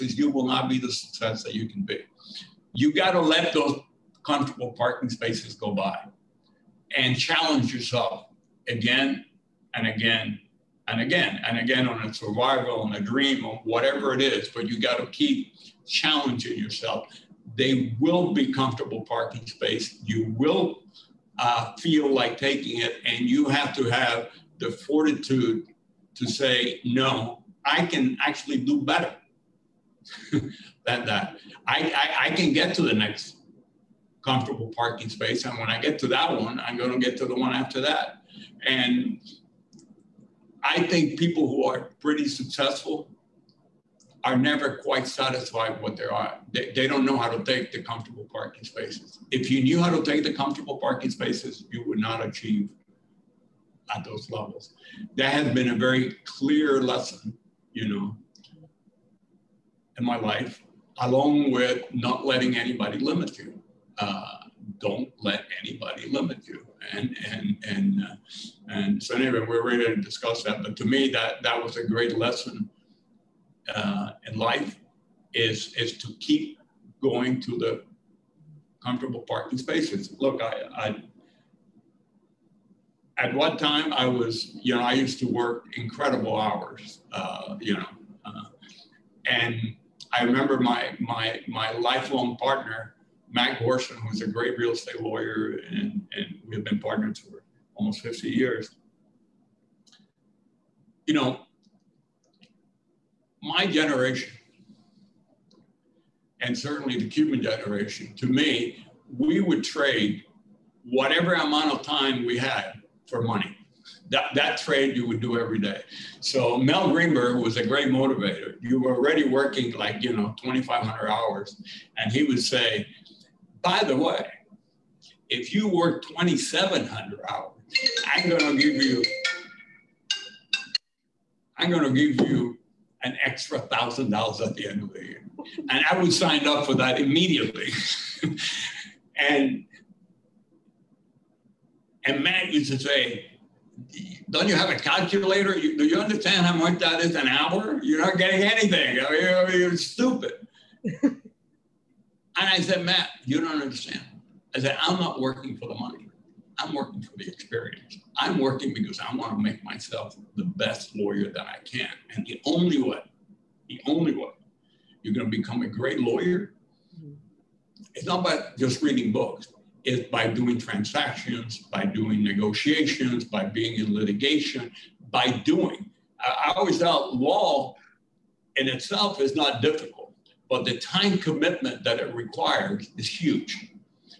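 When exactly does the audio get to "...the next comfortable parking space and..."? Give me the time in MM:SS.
00:32.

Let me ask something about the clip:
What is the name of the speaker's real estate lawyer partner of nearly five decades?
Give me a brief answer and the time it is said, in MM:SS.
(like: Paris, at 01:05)
Matt Gorson, at 01:33.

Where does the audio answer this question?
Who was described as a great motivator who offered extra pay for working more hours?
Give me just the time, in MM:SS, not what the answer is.
01:56.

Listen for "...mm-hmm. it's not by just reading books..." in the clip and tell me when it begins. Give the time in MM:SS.
02:46.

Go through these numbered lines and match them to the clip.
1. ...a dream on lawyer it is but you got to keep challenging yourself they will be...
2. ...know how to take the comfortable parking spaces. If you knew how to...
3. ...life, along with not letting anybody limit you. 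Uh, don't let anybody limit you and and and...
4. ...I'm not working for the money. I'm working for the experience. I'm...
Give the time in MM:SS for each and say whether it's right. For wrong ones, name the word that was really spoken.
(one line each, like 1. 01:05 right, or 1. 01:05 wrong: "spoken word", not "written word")
1. 00:12 wrong: "whatever", not "lawyer"
2. 00:47 right
3. 01:00 right
4. 02:34 right.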